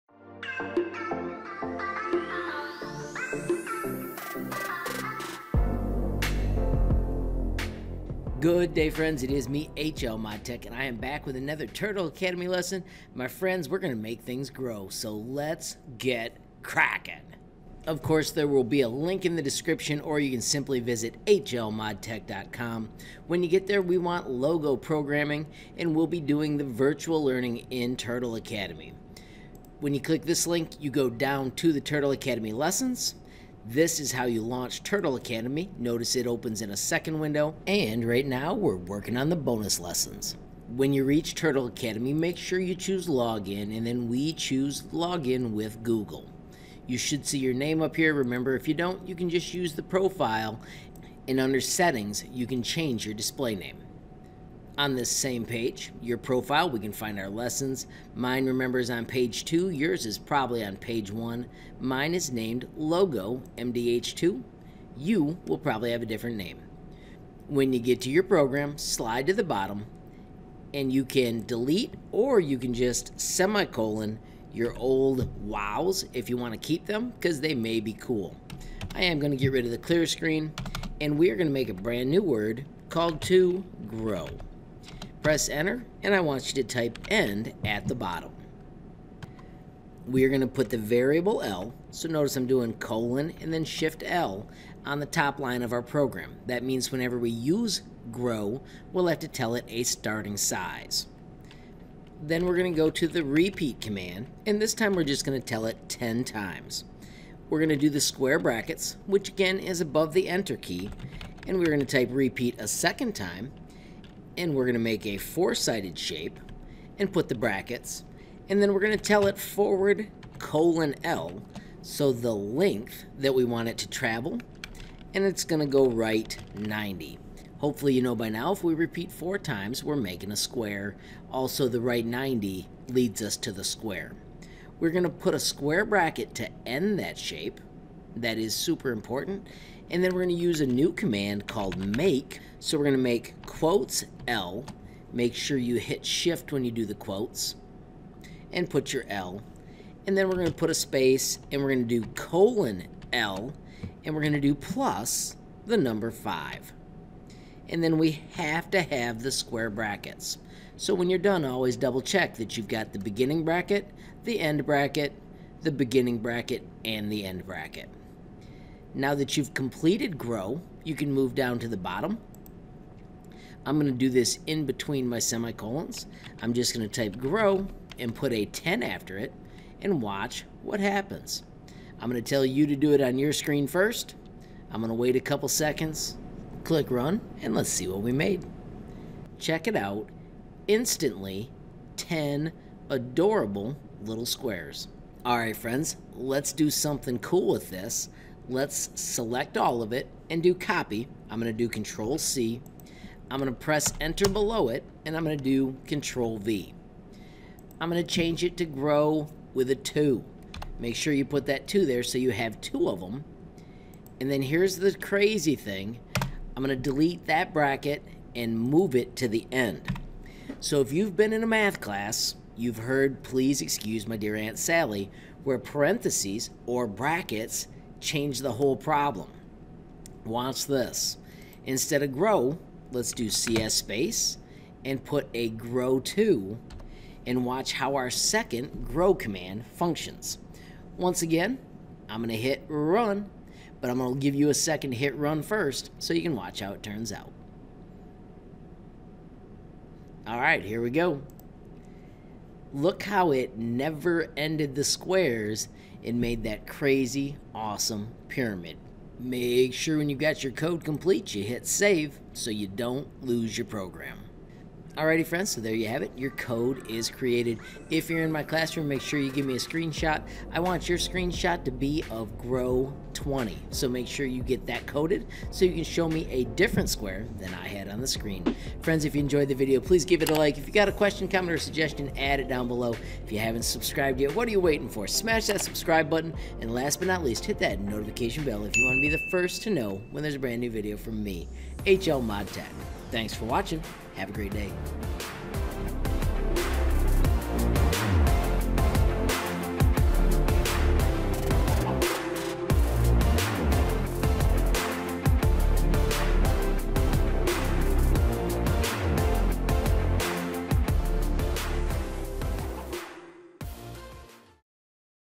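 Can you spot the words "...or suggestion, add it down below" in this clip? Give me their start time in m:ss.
4:41.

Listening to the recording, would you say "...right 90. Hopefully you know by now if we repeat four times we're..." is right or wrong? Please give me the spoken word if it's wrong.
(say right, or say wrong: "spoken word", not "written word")
right.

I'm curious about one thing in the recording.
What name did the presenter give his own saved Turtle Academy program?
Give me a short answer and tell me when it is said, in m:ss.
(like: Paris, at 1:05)
Logo MDH2, at 1:02.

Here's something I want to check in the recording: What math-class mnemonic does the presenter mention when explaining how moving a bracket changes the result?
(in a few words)
Please Excuse My Dear Aunt Sally.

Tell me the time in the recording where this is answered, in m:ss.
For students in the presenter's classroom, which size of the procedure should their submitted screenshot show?
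4:32.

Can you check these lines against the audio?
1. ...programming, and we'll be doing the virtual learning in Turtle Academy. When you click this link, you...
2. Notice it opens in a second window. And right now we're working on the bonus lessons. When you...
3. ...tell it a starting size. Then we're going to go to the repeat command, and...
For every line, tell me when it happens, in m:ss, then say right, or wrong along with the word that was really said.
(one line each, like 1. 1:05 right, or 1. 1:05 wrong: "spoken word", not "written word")
1. 0:24 right
2. 0:35 right
3. 1:39 right.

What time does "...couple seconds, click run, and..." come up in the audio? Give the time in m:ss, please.
3:05.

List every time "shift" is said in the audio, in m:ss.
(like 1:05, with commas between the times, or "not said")
1:33, 2:26.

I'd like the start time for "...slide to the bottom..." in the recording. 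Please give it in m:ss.
1:08.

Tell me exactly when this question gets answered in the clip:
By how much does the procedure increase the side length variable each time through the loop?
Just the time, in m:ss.
2:35.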